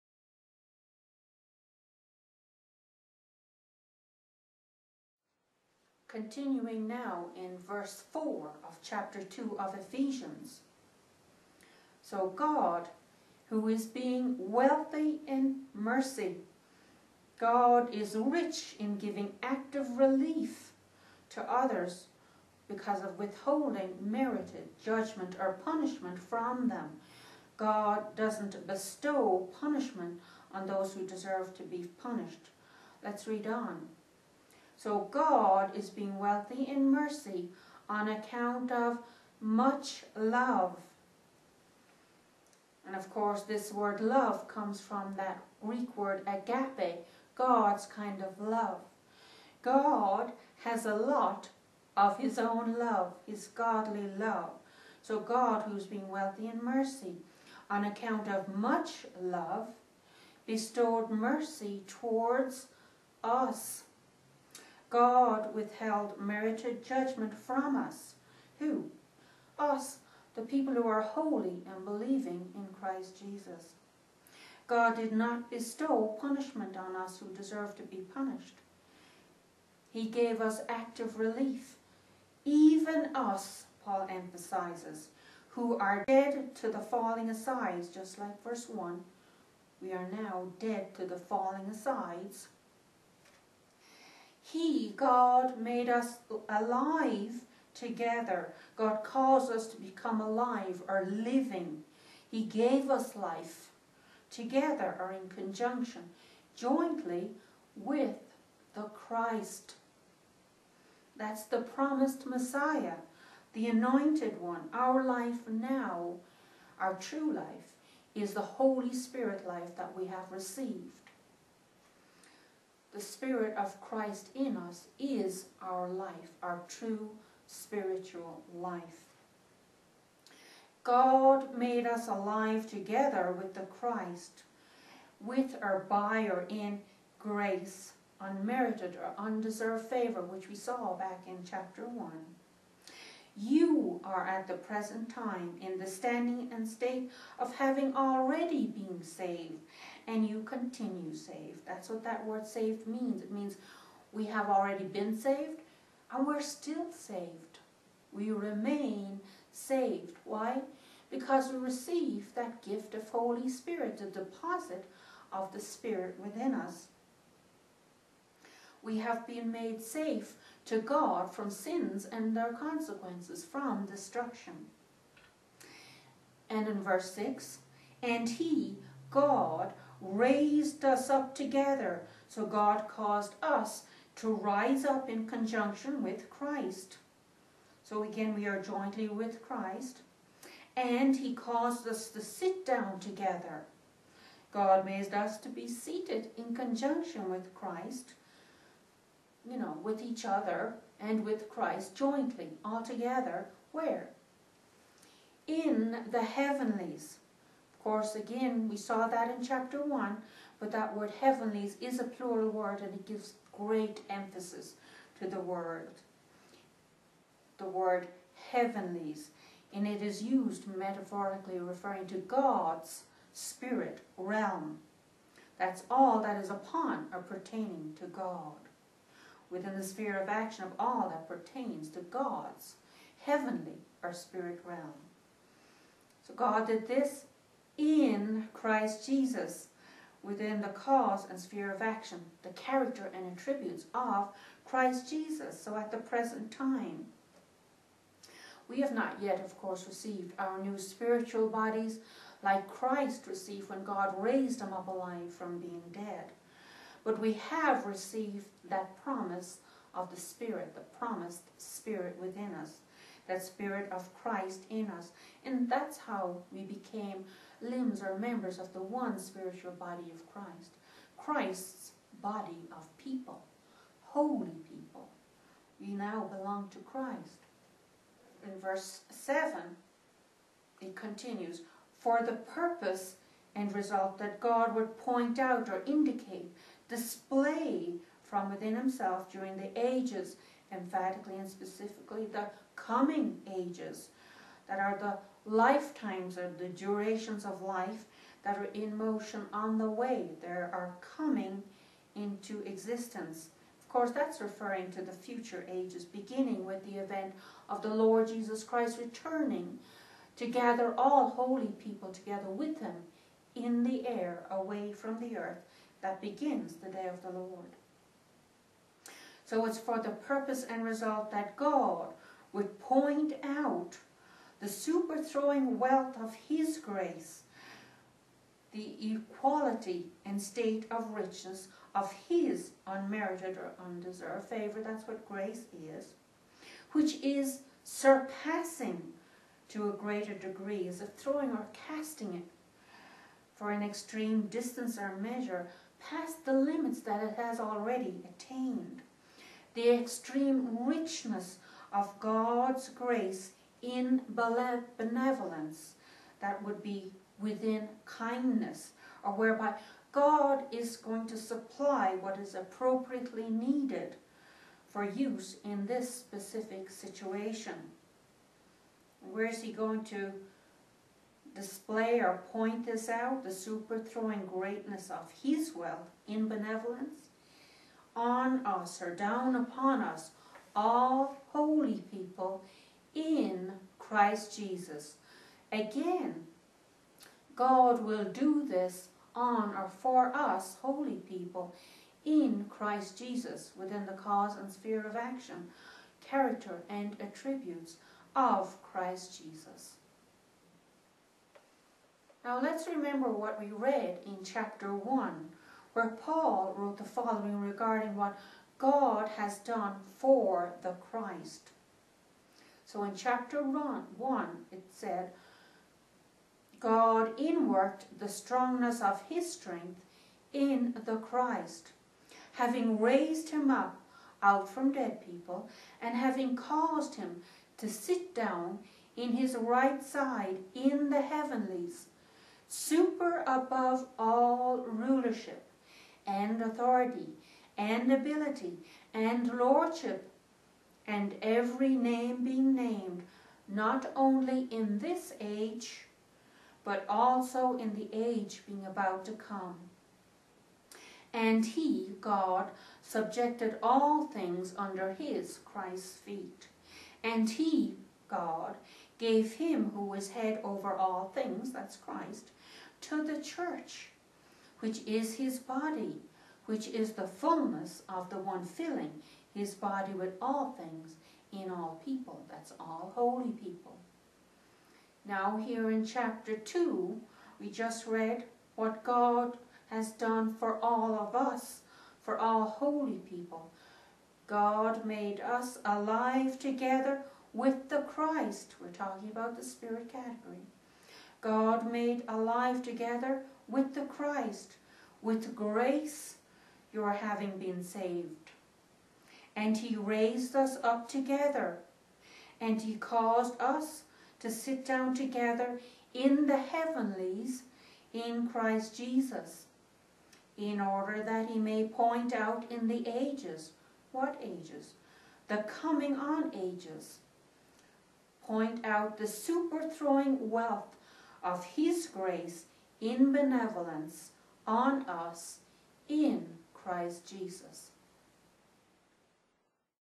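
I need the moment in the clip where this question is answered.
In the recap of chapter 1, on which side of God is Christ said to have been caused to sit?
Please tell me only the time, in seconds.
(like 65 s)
429 s.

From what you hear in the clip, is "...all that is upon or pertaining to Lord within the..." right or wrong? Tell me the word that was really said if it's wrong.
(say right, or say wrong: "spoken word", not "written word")
wrong: "God", not "Lord".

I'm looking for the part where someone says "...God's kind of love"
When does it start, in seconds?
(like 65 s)
47 s.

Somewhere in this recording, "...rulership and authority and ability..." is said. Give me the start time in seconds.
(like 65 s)
434 s.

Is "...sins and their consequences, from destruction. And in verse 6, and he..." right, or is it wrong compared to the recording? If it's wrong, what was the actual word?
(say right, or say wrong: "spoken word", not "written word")
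right.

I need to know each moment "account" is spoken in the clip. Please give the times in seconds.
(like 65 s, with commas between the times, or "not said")
38 s, 57 s.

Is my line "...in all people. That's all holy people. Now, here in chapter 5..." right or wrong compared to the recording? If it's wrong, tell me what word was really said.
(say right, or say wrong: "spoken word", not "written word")
wrong: "2", not "5".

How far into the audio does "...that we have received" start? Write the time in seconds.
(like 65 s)
119 s.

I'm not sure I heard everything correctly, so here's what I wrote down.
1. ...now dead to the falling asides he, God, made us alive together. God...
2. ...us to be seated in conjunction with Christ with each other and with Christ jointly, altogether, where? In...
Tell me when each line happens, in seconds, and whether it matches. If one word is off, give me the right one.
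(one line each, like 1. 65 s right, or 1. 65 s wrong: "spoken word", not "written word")
1. 90 s right
2. 195 s right.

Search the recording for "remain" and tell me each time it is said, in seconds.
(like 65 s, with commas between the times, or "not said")
158 s.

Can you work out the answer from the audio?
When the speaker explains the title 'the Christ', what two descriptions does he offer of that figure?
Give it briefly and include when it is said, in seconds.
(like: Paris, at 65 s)
the promised Messiah, the anointed one, at 111 s.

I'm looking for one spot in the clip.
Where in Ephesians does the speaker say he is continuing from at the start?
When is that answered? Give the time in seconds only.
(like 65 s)
7 s.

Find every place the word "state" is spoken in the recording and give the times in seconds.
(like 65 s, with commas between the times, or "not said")
146 s, 330 s.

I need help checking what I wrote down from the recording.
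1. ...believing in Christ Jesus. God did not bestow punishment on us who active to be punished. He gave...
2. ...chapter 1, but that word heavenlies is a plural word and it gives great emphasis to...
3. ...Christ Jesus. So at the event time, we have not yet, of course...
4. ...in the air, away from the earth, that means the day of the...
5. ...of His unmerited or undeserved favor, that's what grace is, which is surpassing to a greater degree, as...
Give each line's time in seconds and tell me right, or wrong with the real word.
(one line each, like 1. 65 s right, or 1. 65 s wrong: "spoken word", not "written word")
1. 71 s wrong: "deserve", not "active"
2. 209 s right
3. 244 s wrong: "present", not "event"
4. 313 s wrong: "begins", not "means"
5. 331 s right.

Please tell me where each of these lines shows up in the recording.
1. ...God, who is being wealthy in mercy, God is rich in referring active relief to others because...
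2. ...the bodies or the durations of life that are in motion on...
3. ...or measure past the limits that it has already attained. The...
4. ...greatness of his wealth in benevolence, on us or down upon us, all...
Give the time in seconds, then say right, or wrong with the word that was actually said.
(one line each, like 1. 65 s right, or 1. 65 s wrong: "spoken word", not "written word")
1. 12 s wrong: "giving", not "referring"
2. 294 s wrong: "lifetimes", not "bodies"
3. 344 s right
4. 374 s right.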